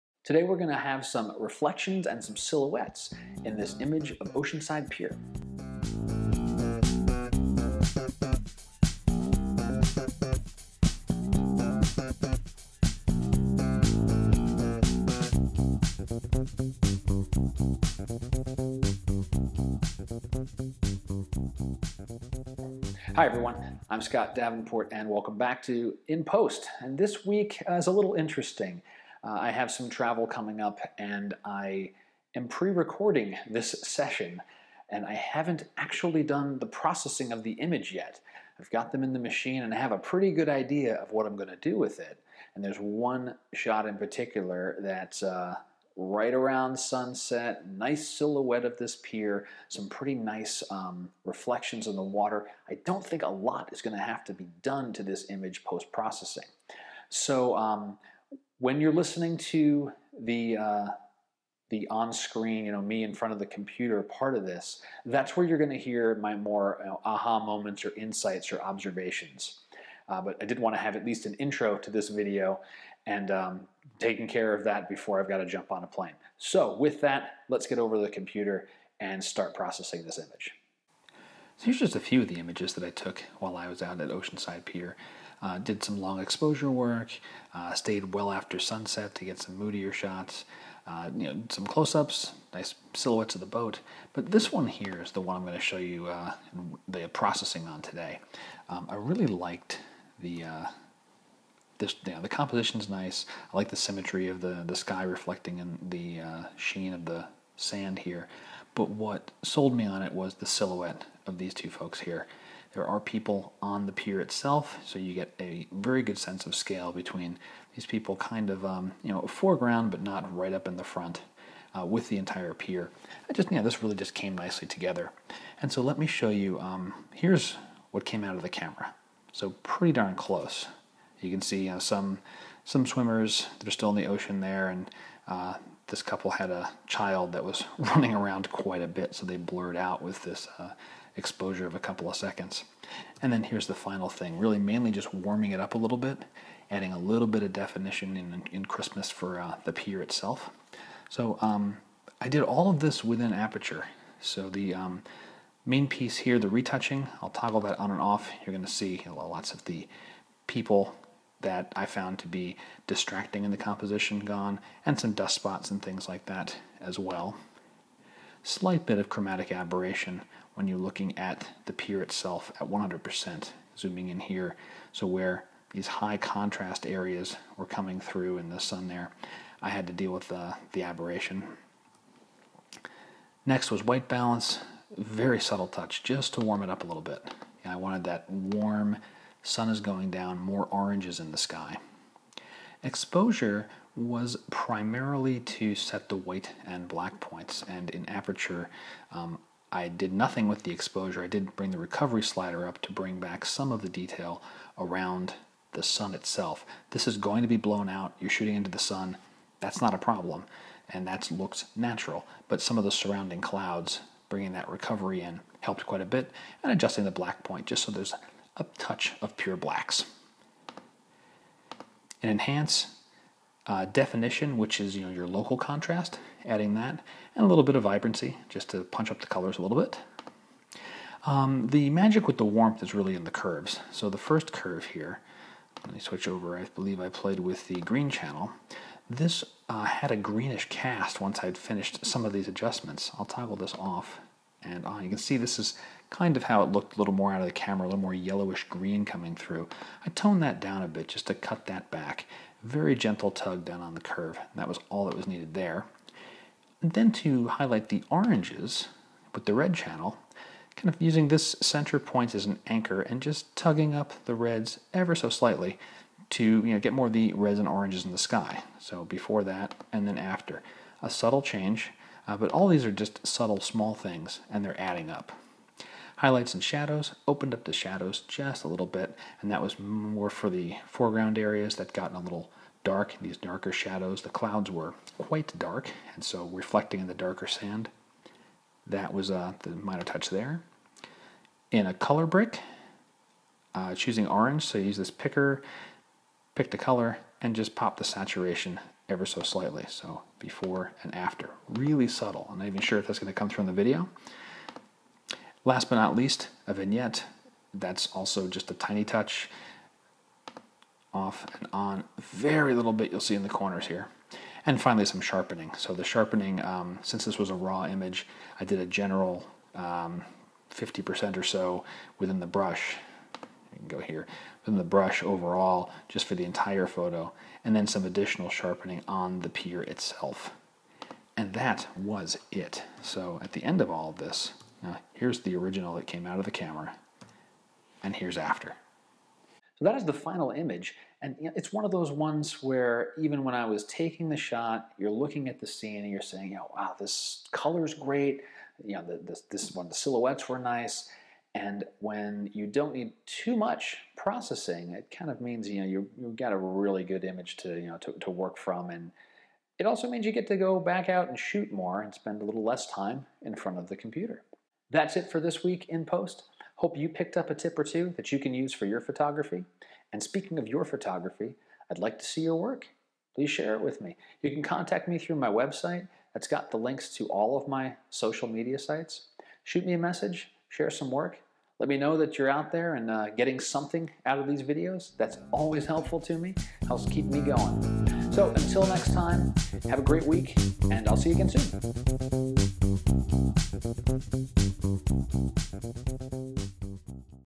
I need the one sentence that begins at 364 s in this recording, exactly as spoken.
That's it for this week in post.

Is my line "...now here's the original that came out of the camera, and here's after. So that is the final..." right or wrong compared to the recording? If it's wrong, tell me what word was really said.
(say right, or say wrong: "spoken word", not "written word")
right.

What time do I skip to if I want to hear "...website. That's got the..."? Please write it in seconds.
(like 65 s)
375 s.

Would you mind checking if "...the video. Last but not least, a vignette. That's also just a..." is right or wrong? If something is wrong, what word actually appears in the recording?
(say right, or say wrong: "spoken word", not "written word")
right.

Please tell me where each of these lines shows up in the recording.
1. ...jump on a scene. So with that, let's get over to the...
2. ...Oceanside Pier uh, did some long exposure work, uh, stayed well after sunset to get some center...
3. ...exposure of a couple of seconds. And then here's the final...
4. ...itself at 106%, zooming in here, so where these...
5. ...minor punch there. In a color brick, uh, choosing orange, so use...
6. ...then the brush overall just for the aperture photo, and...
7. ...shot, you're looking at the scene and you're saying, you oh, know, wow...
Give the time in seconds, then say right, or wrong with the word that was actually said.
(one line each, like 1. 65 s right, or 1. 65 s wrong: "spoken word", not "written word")
1. 75 s wrong: "plane", not "scene"
2. 84 s wrong: "moodier", not "center"
3. 141 s right
4. 172 s wrong: "100", not "106"
5. 289 s wrong: "touch", not "punch"
6. 324 s wrong: "entire", not "aperture"
7. 344 s right.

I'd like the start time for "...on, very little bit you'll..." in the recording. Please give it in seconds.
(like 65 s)
311 s.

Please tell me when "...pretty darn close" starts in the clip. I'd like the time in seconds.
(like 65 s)
129 s.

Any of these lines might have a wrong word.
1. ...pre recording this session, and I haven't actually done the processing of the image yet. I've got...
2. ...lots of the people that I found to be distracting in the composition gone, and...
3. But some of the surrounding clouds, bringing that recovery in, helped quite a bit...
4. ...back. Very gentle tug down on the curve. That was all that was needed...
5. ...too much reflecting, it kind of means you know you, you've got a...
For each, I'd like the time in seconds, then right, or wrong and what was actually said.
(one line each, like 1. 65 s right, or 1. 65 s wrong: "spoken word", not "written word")
1. 32 s right
2. 159 s right
3. 212 s right
4. 251 s right
5. 353 s wrong: "processing", not "reflecting".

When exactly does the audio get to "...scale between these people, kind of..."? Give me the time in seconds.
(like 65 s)
116 s.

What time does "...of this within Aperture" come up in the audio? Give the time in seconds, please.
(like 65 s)
152 s.